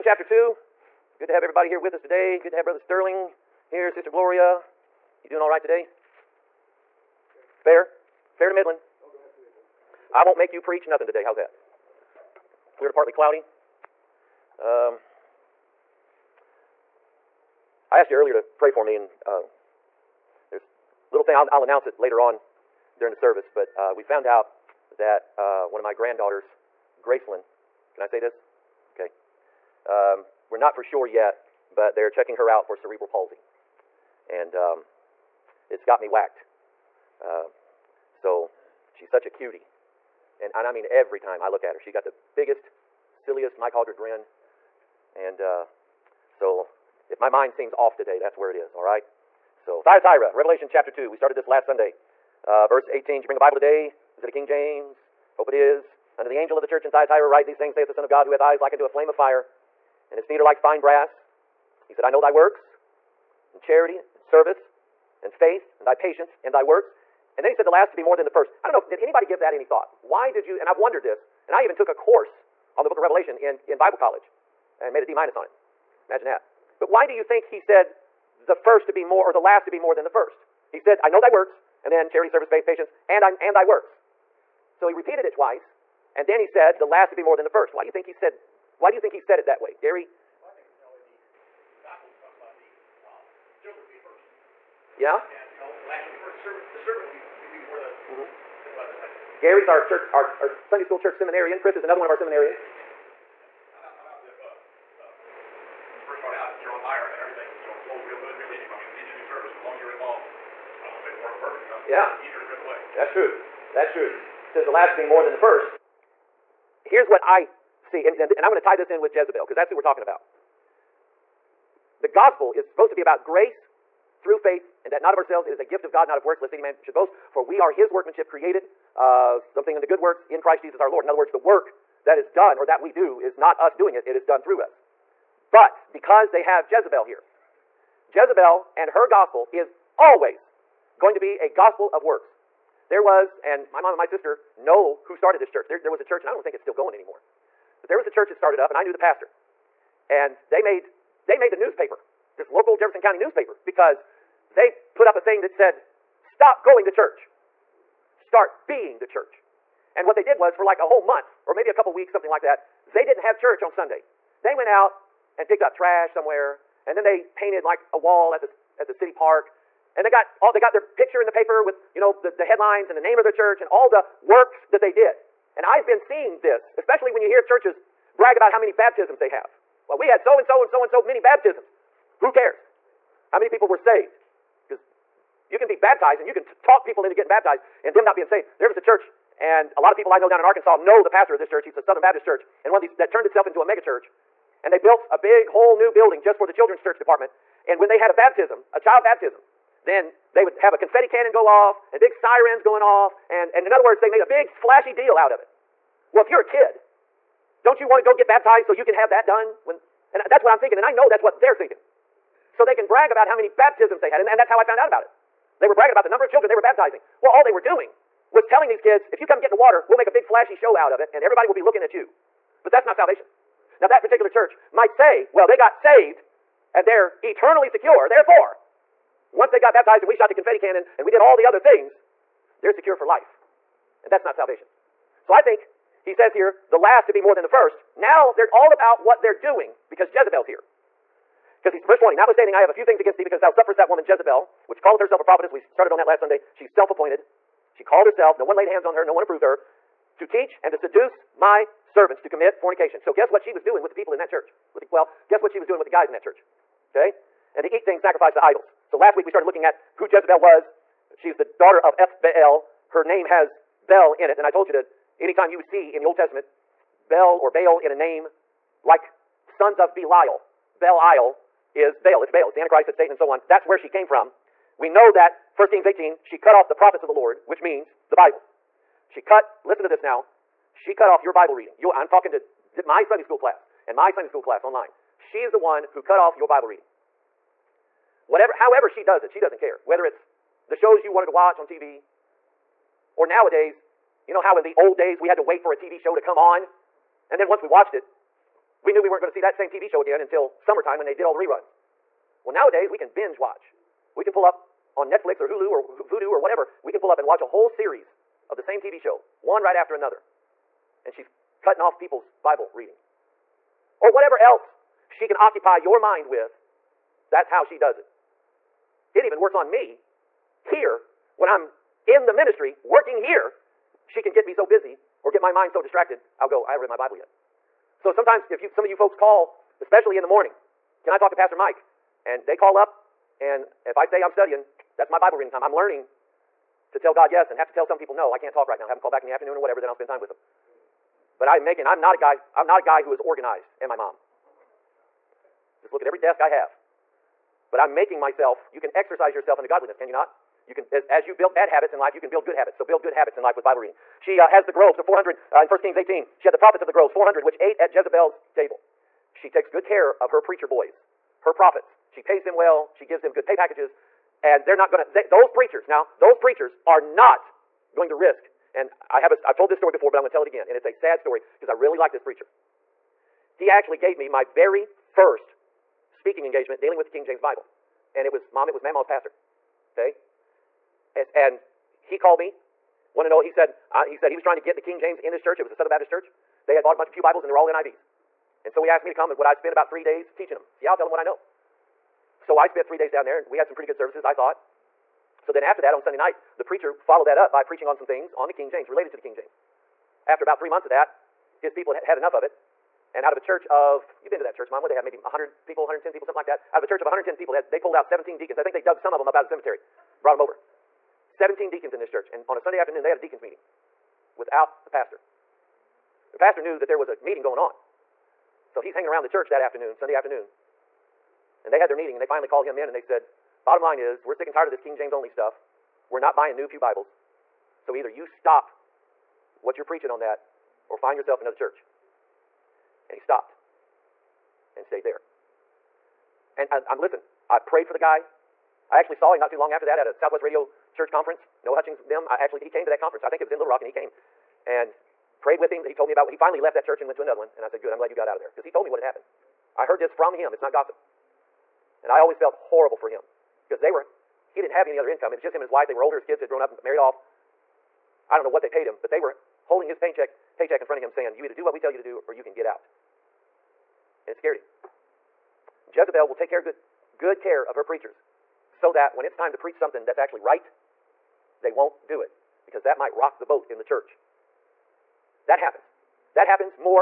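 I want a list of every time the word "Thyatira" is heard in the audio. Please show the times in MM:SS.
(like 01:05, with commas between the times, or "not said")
00:49, 00:56.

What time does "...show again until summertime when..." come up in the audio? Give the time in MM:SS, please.
04:59.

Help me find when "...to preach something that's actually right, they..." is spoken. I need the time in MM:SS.
07:49.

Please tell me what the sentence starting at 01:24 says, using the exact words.
So he repeated it twice, and then he said, the last to be more than the first.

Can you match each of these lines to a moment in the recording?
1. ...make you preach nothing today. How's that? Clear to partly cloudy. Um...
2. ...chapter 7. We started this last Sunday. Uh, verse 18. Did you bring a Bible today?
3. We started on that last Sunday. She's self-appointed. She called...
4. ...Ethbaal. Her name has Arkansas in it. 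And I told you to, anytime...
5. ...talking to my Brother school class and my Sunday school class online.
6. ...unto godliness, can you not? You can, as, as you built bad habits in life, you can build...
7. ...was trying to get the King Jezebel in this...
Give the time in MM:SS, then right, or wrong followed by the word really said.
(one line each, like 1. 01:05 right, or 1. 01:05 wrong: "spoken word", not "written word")
1. 00:10 right
2. 00:50 wrong: "2", not "7"
3. 04:05 right
4. 04:21 wrong: "Bel", not "Arkansas"
5. 04:42 wrong: "Sunday", not "Brother"
6. 05:49 right
7. 06:24 wrong: "James", not "Jezebel".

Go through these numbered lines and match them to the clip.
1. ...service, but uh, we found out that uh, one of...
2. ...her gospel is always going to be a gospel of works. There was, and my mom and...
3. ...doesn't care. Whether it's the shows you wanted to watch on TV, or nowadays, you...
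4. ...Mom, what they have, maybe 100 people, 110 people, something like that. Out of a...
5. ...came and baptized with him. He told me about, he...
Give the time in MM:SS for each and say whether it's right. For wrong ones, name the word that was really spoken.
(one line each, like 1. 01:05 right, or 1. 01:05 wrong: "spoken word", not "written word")
1. 00:23 right
2. 02:18 right
3. 04:49 right
4. 06:44 right
5. 07:23 wrong: "prayed", not "baptized".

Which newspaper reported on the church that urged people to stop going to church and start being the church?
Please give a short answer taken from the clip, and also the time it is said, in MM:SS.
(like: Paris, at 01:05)
Jefferson County newspaper, at 02:32.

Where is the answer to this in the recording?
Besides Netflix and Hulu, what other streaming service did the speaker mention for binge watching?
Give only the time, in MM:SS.
05:06.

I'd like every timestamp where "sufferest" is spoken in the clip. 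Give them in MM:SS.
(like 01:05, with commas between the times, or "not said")
04:03.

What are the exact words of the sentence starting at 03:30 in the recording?
And I know that's what they're thinking.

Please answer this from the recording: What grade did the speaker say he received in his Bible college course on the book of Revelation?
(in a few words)
D minus.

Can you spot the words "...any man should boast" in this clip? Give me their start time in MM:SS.
02:06.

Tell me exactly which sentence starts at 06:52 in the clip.
And on a Sunday afternoon, they had a deacons meeting without the pastor.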